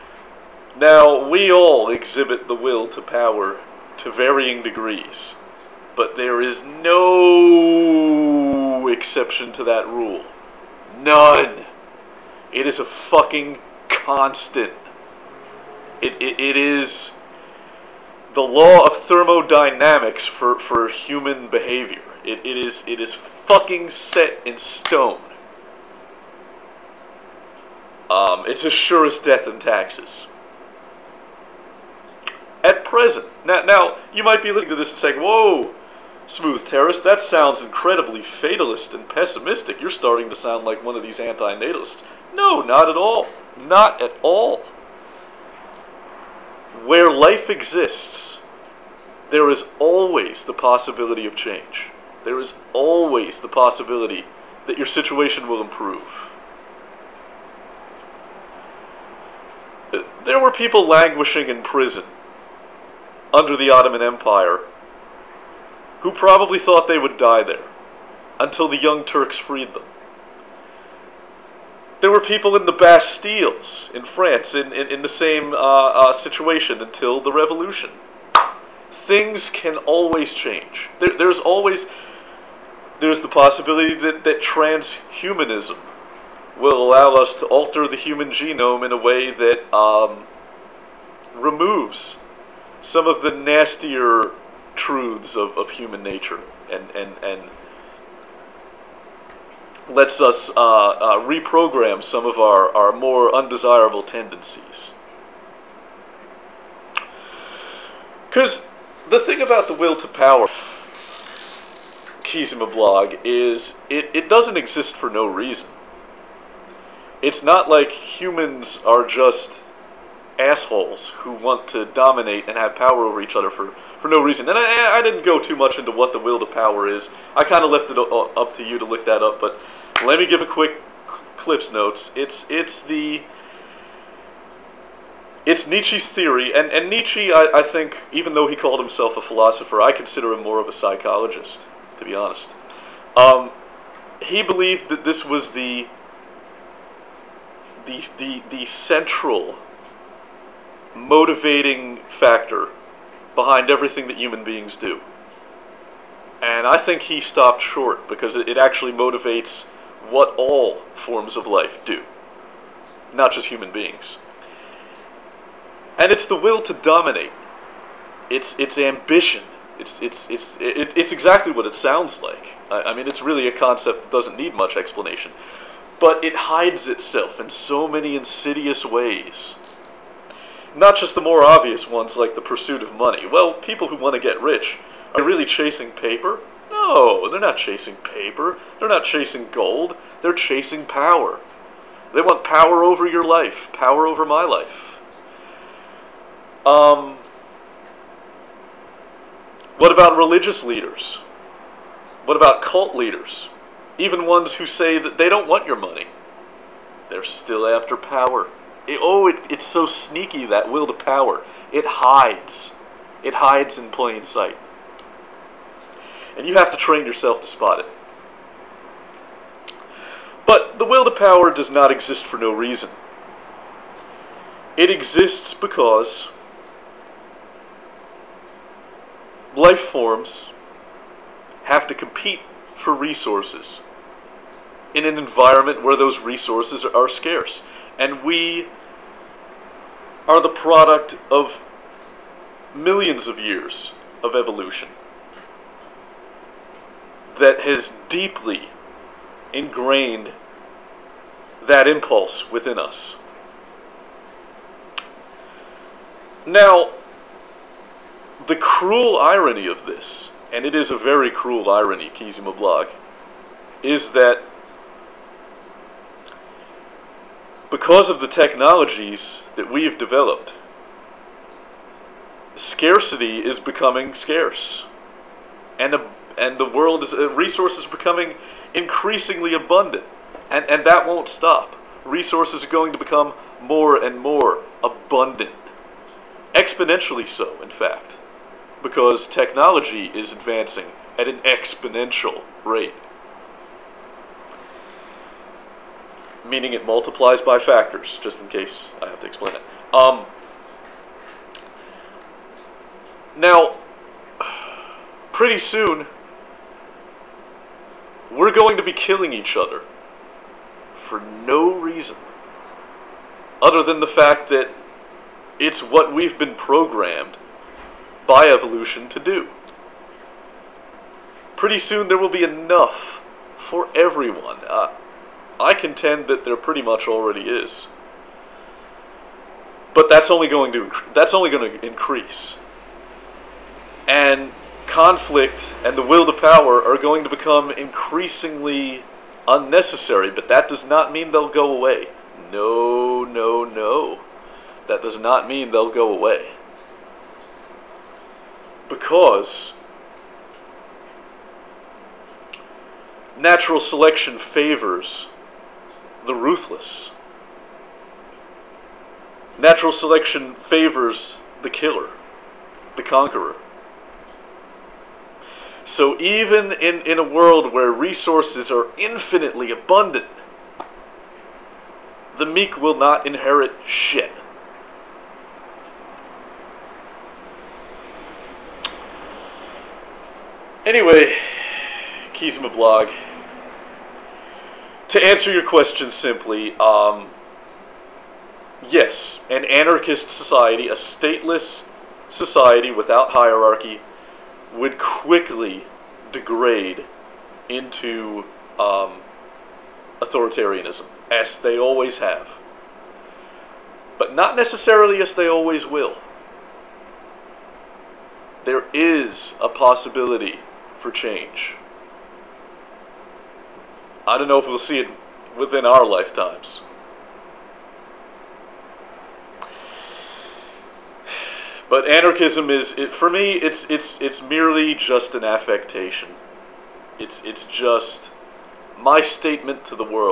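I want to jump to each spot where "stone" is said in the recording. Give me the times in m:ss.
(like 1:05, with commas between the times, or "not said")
0:24.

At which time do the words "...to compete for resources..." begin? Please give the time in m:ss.
3:51.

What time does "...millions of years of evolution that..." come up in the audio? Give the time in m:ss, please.
4:02.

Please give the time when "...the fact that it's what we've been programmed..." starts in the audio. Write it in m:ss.
5:14.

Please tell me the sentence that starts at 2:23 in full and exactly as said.
Um, he believed that this was the the, the, the central motivating factor behind everything that human beings do.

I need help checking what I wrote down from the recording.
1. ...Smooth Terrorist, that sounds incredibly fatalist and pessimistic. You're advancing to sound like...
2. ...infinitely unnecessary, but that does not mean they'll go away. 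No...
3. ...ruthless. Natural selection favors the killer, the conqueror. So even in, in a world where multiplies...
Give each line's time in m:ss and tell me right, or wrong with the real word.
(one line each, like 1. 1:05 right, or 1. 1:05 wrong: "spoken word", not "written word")
1. 0:36 wrong: "starting", not "advancing"
2. 5:37 wrong: "increasingly", not "infinitely"
3. 5:56 wrong: "resources", not "multiplies".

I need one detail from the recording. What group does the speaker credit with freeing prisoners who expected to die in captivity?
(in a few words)
the Young Turks.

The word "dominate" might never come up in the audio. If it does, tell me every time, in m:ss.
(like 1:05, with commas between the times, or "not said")
2:01, 2:46.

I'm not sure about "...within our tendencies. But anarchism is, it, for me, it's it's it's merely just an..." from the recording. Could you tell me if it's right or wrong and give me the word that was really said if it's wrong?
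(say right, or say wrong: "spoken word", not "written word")
wrong: "lifetimes", not "tendencies".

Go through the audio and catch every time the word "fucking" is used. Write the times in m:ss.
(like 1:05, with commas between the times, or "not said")
0:12, 0:23.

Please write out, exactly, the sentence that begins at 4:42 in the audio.
Resources are going to become more and more abundant, exponentially so, in fact, because technology is advancing at an exponential rate.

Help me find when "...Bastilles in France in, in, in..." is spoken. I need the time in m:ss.
1:12.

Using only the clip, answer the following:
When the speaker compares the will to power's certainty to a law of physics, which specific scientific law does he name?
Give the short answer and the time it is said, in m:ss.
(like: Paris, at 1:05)
the law of thermodynamics, at 0:18.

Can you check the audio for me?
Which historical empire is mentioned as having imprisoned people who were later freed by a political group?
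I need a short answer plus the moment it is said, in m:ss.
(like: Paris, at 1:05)
Ottoman Empire, at 1:03.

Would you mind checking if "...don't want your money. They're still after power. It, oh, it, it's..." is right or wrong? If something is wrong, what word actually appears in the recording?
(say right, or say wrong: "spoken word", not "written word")
right.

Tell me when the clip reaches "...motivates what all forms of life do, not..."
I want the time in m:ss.
2:38.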